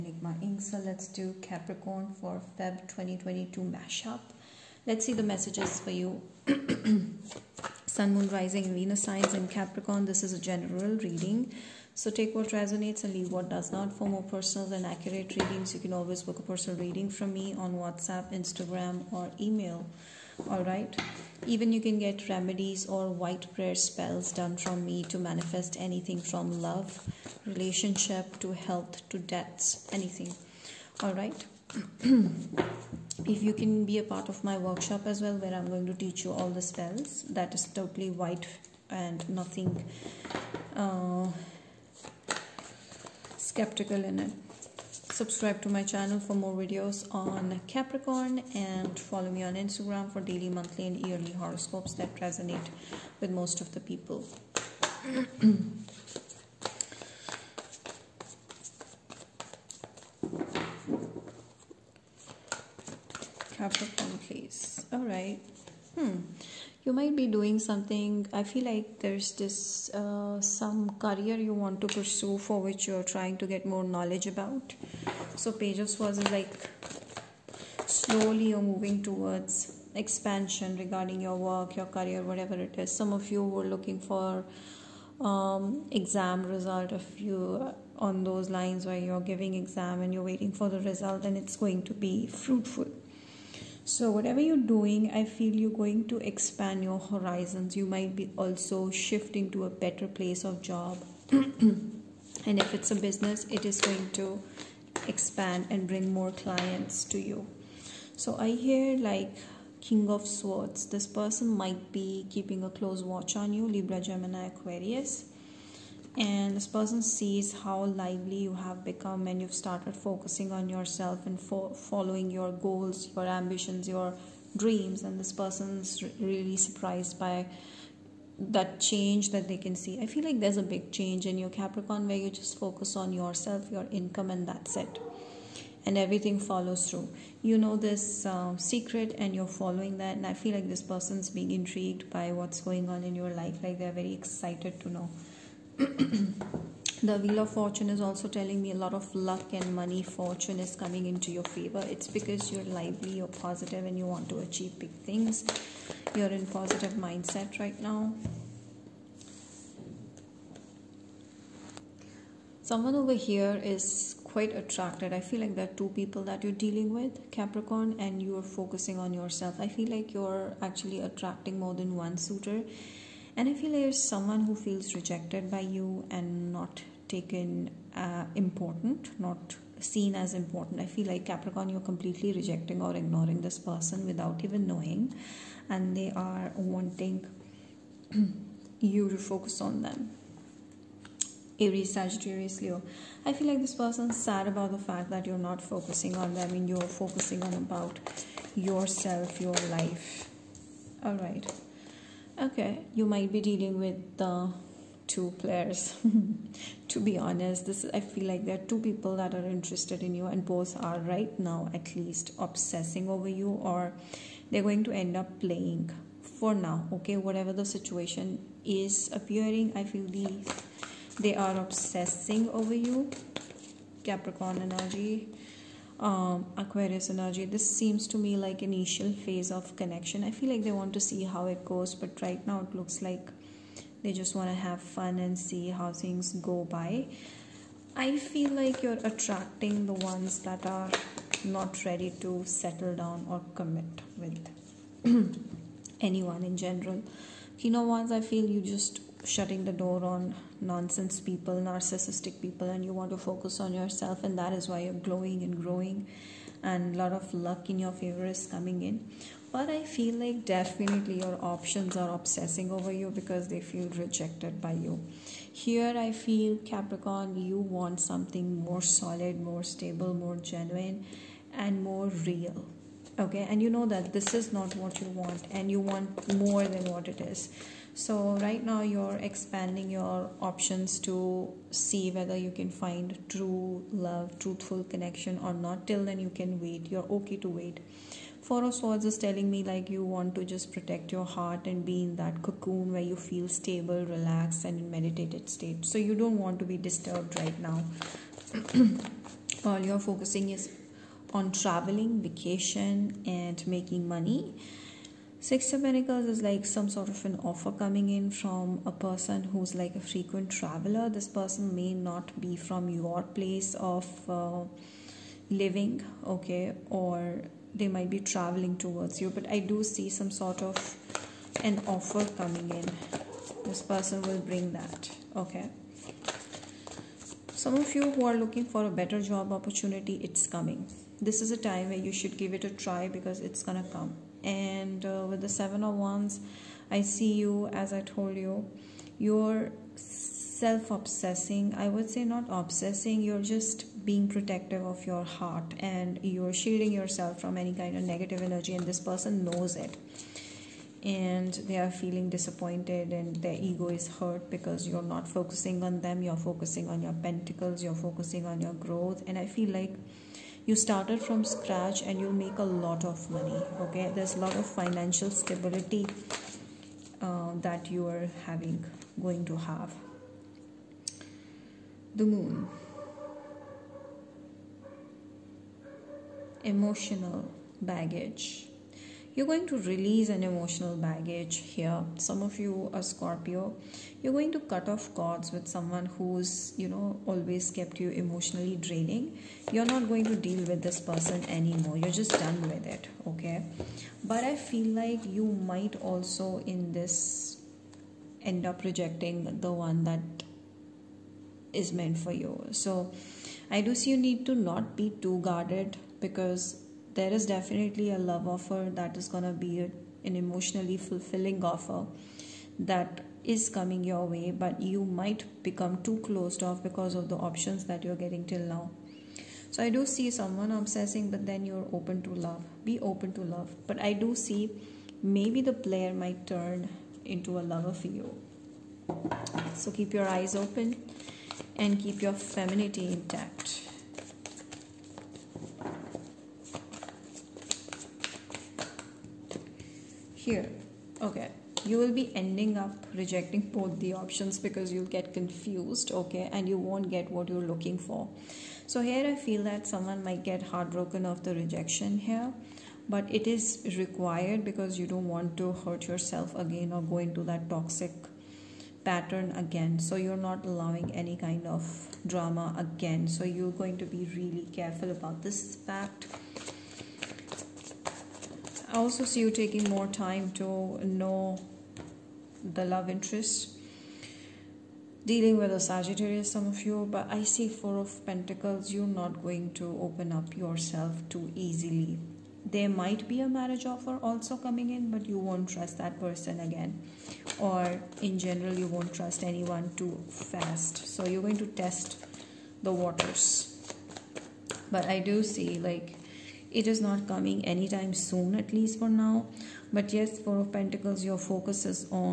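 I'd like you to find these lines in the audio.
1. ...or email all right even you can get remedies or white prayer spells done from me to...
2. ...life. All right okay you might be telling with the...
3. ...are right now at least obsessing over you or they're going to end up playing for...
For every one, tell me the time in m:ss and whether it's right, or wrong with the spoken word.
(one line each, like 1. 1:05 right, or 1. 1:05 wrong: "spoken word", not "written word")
1. 0:19 right
2. 3:19 wrong: "dealing", not "telling"
3. 3:30 right.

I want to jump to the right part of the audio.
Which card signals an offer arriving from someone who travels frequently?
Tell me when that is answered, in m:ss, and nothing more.
5:05.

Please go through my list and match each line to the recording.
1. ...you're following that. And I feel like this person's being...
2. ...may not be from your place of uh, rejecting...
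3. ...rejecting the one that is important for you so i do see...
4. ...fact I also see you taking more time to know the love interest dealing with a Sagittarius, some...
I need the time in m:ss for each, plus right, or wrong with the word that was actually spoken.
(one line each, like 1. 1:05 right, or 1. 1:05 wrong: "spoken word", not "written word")
1. 2:19 right
2. 5:11 wrong: "living", not "rejecting"
3. 6:38 wrong: "meant", not "important"
4. 7:45 right.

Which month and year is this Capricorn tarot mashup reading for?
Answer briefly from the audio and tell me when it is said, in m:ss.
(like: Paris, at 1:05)
February 2022, at 0:02.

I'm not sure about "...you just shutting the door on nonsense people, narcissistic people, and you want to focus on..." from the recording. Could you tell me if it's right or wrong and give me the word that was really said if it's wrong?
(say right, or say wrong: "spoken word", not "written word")
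right.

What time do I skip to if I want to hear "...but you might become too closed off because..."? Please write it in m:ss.
6:54.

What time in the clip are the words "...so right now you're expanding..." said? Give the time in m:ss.
4:38.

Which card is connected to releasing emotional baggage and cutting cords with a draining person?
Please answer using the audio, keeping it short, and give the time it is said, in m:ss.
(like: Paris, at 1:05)
The Moon, at 6:12.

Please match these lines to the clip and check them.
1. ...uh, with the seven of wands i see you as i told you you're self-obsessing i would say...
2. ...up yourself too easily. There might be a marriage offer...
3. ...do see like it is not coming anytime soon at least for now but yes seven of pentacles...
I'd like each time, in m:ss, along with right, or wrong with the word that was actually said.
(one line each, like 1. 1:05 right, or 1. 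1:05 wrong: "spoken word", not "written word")
1. 5:35 right
2. 8:00 right
3. 8:15 wrong: "four", not "seven".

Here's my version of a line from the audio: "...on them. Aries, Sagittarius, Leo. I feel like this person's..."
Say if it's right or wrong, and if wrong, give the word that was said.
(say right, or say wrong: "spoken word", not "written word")
right.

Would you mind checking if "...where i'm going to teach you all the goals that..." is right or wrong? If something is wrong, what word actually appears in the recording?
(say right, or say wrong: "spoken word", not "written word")
wrong: "spells", not "goals".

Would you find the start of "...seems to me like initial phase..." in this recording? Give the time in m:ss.
3:47.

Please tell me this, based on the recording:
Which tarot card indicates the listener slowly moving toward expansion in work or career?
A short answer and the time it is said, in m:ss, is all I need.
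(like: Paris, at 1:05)
Page of Swords, at 1:15.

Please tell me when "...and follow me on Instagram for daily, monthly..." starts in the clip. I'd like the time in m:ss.
0:48.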